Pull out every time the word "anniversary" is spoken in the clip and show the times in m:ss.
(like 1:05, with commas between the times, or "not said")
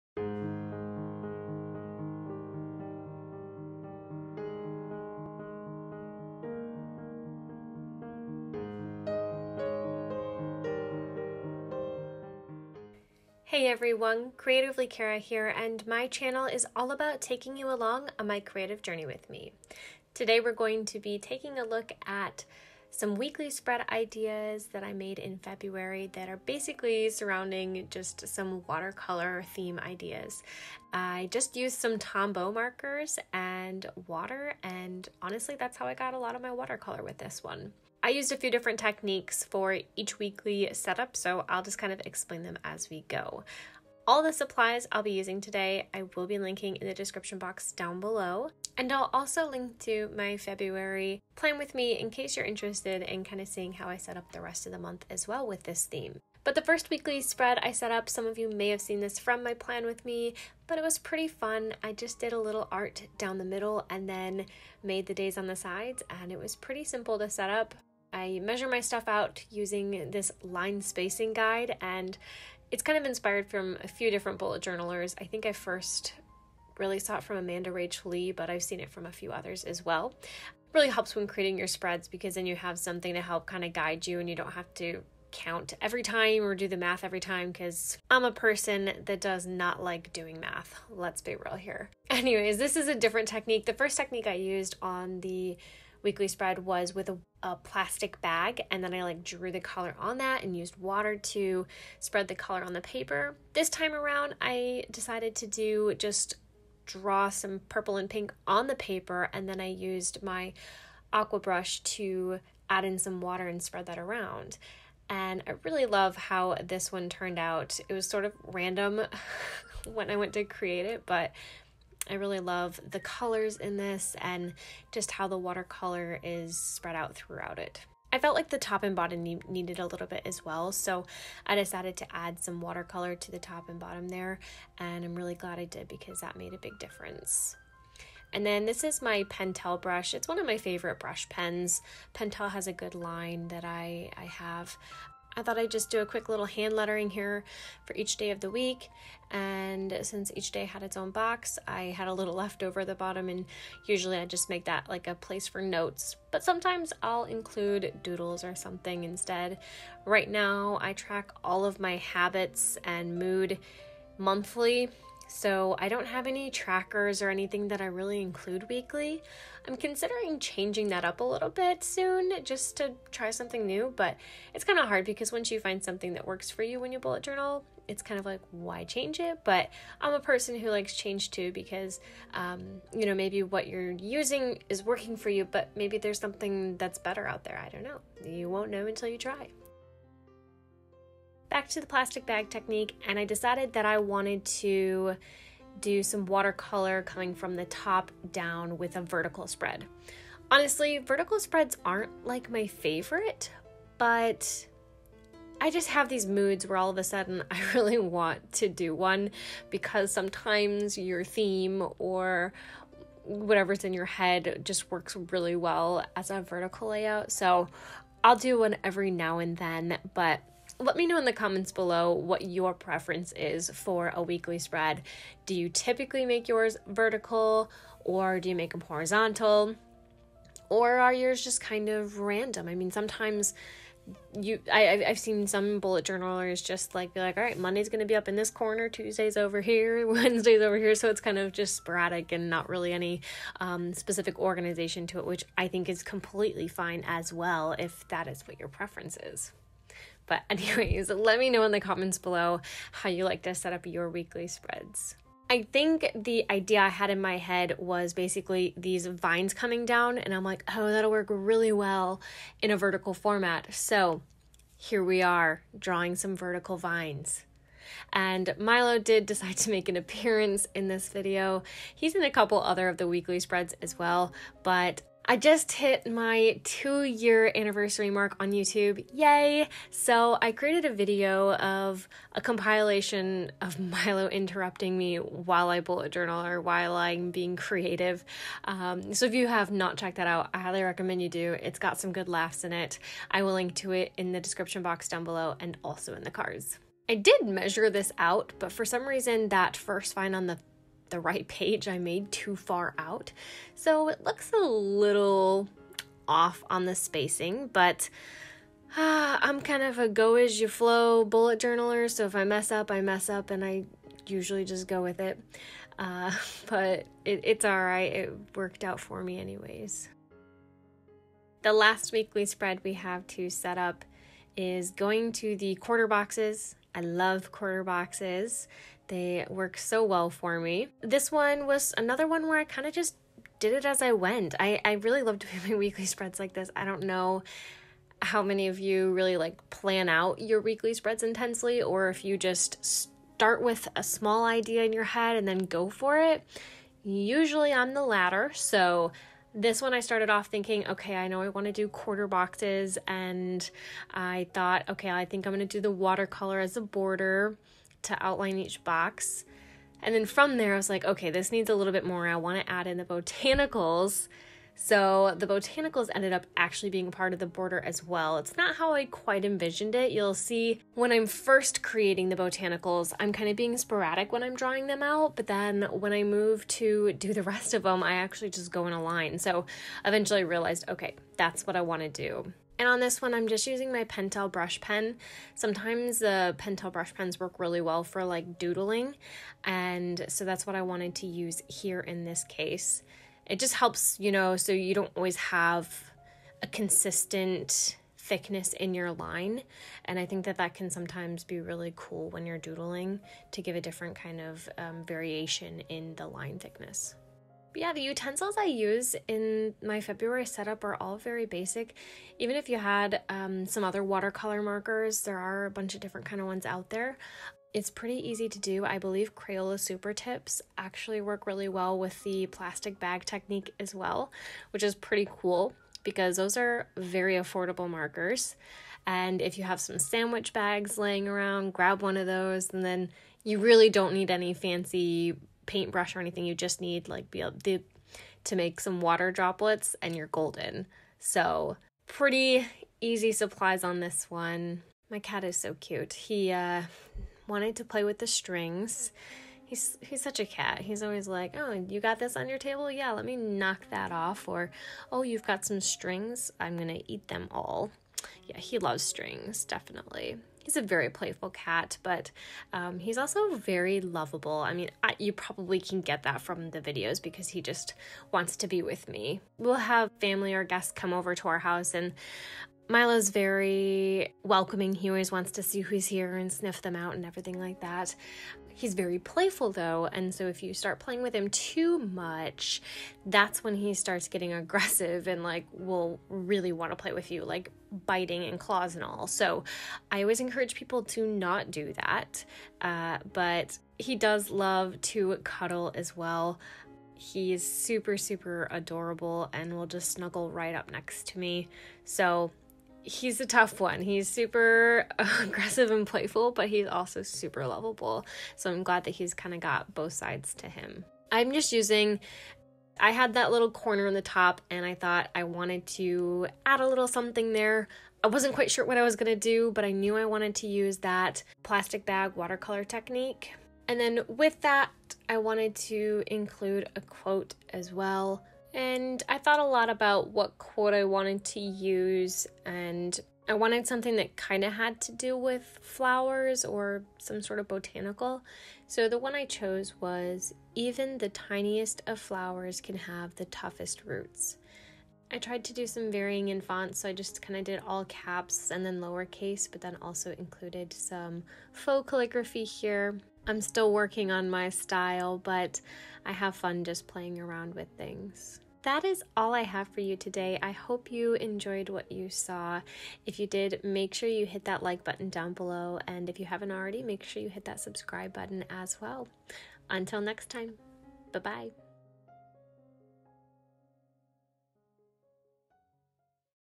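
4:37.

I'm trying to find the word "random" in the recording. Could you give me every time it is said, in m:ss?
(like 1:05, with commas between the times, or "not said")
1:58, 3:52.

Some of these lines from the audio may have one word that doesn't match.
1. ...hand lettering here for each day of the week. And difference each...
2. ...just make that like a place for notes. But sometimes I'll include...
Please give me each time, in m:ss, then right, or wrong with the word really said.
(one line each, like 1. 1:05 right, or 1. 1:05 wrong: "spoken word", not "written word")
1. 2:26 wrong: "since", not "difference"
2. 2:34 right.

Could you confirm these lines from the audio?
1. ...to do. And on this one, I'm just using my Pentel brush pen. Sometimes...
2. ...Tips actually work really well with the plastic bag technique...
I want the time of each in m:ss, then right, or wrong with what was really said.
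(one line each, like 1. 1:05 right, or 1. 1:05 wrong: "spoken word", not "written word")
1. 6:22 right
2. 7:00 right.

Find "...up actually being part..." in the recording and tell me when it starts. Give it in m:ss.
6:06.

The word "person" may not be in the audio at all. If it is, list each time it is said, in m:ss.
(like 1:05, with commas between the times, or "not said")
1:28, 3:00.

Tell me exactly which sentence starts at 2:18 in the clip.
And then this is my Pentel brush.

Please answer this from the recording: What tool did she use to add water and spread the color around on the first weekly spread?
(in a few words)
aqua brush.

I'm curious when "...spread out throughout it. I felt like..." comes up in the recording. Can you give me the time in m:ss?
2:06.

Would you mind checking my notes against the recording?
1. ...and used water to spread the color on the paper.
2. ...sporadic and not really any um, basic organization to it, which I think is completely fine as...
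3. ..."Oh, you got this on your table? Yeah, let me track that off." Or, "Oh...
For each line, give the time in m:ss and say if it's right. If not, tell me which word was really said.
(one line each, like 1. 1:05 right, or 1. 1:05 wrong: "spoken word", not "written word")
1. 1:40 right
2. 4:01 wrong: "specific", not "basic"
3. 7:31 wrong: "knock", not "track".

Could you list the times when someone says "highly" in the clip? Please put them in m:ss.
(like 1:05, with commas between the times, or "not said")
4:50.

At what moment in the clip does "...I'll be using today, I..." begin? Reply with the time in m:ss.
0:44.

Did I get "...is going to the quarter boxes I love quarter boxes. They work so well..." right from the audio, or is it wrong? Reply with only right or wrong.
right.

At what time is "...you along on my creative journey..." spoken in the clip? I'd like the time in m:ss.
0:17.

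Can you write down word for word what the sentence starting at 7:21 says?
So pretty easy supplies on this one.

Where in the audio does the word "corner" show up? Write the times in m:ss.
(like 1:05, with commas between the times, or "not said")
3:58, 8:33.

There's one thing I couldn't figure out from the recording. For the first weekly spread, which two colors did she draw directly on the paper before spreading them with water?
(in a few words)
purple and pink.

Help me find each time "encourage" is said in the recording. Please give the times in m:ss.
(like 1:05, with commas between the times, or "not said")
8:10.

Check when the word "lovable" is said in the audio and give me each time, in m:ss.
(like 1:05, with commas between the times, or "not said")
7:43, 8:27.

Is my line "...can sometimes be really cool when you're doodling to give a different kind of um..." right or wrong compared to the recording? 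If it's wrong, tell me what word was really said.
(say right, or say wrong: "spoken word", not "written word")
right.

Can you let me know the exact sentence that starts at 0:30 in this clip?
I just used some Tombow markers and water, and honestly, that's how I got a lot of my watercolor with this one.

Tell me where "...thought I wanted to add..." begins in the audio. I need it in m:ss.
8:34.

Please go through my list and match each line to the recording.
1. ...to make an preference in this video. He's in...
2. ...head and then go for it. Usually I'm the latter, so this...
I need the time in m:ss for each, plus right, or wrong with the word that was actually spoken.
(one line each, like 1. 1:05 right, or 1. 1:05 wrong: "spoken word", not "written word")
1. 4:29 wrong: "appearance", not "preference"
2. 5:45 right.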